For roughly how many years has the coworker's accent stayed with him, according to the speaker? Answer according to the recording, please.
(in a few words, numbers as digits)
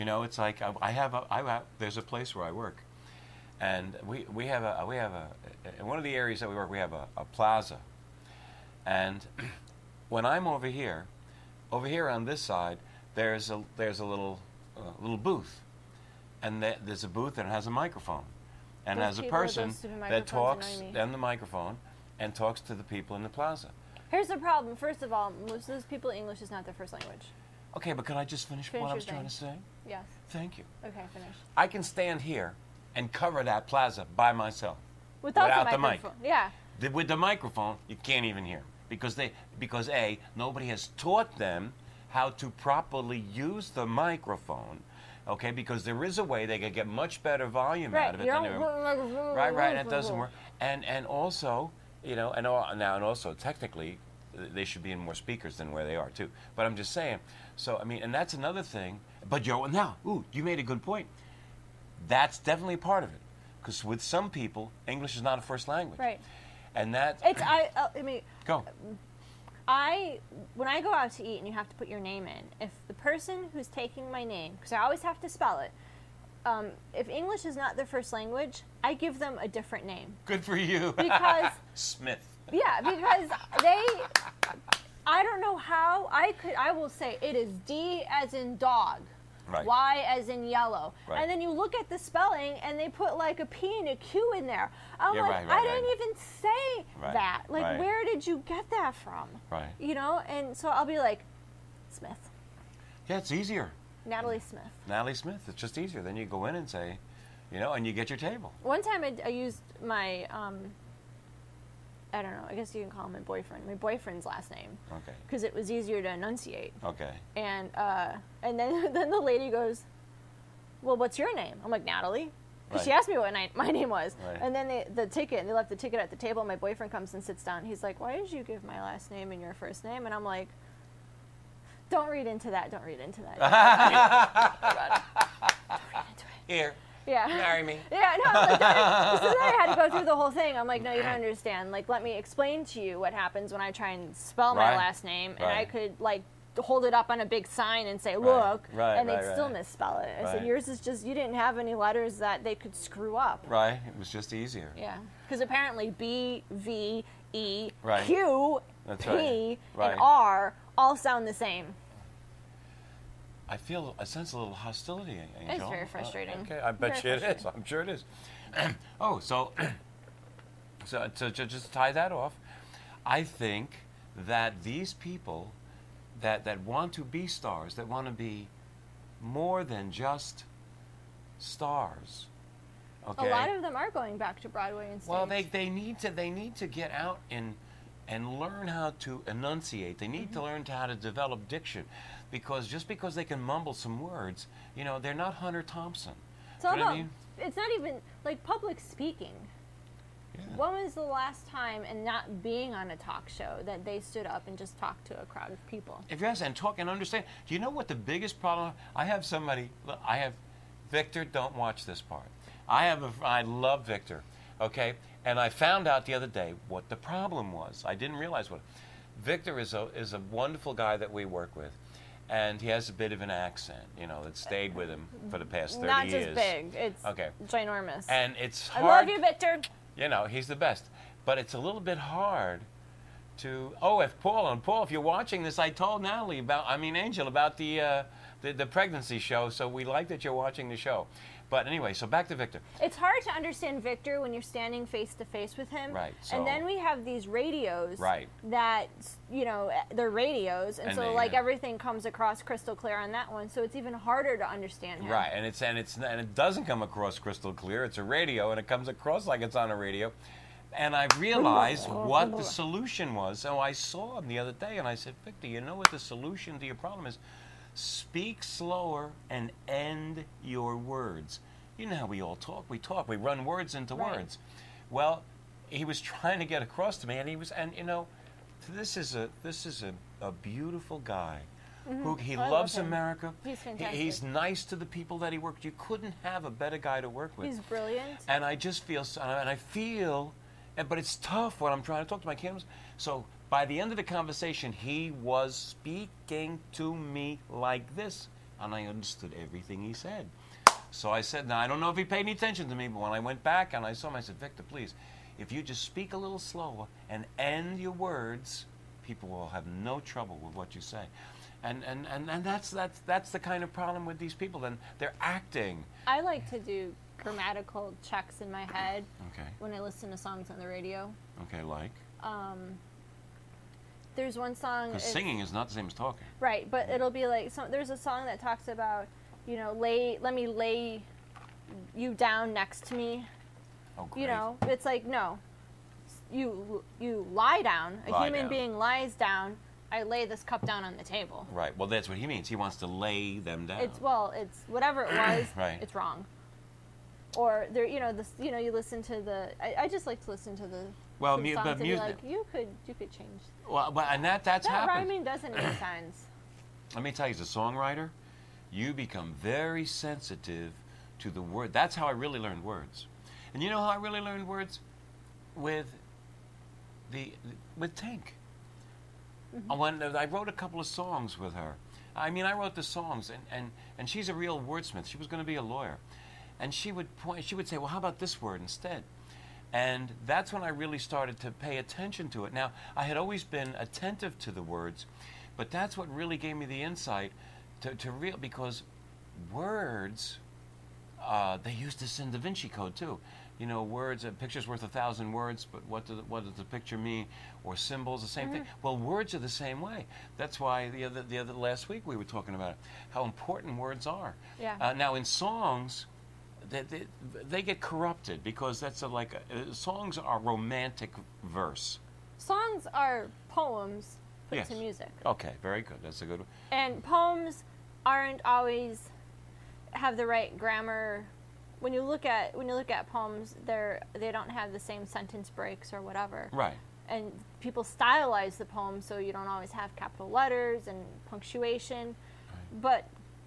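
30 years.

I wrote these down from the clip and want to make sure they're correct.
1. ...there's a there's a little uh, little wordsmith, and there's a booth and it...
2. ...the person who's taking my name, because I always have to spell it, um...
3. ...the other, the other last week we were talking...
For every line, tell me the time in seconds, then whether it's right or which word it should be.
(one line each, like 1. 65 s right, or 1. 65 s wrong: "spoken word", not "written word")
1. 13 s wrong: "booth", not "wordsmith"
2. 72 s right
3. 400 s right.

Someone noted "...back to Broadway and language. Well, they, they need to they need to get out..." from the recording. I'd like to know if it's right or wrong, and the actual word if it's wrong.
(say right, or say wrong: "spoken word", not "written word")
wrong: "stage", not "language".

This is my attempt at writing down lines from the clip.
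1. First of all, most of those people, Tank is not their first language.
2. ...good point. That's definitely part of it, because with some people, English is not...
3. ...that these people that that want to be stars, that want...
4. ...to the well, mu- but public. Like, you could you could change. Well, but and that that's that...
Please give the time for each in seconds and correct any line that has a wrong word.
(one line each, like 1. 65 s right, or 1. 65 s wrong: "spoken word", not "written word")
1. 24 s wrong: "English", not "Tank"
2. 60 s right
3. 174 s right
4. 350 s wrong: "music", not "public".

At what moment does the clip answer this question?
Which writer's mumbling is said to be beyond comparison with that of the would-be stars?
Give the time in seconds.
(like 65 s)
195 s.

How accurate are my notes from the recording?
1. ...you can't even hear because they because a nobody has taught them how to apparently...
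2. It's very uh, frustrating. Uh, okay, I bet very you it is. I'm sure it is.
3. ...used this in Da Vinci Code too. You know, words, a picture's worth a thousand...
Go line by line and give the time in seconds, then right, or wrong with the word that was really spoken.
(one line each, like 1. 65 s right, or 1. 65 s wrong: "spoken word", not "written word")
1. 37 s wrong: "properly", not "apparently"
2. 165 s right
3. 391 s right.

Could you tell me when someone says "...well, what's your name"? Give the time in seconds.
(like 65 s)
120 s.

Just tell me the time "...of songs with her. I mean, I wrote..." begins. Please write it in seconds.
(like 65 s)
370 s.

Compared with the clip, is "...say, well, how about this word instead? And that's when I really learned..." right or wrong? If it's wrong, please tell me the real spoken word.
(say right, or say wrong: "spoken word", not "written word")
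wrong: "started", not "learned".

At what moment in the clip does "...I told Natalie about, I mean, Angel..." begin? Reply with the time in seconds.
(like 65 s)
235 s.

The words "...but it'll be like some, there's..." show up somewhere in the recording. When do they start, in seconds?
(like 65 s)
326 s.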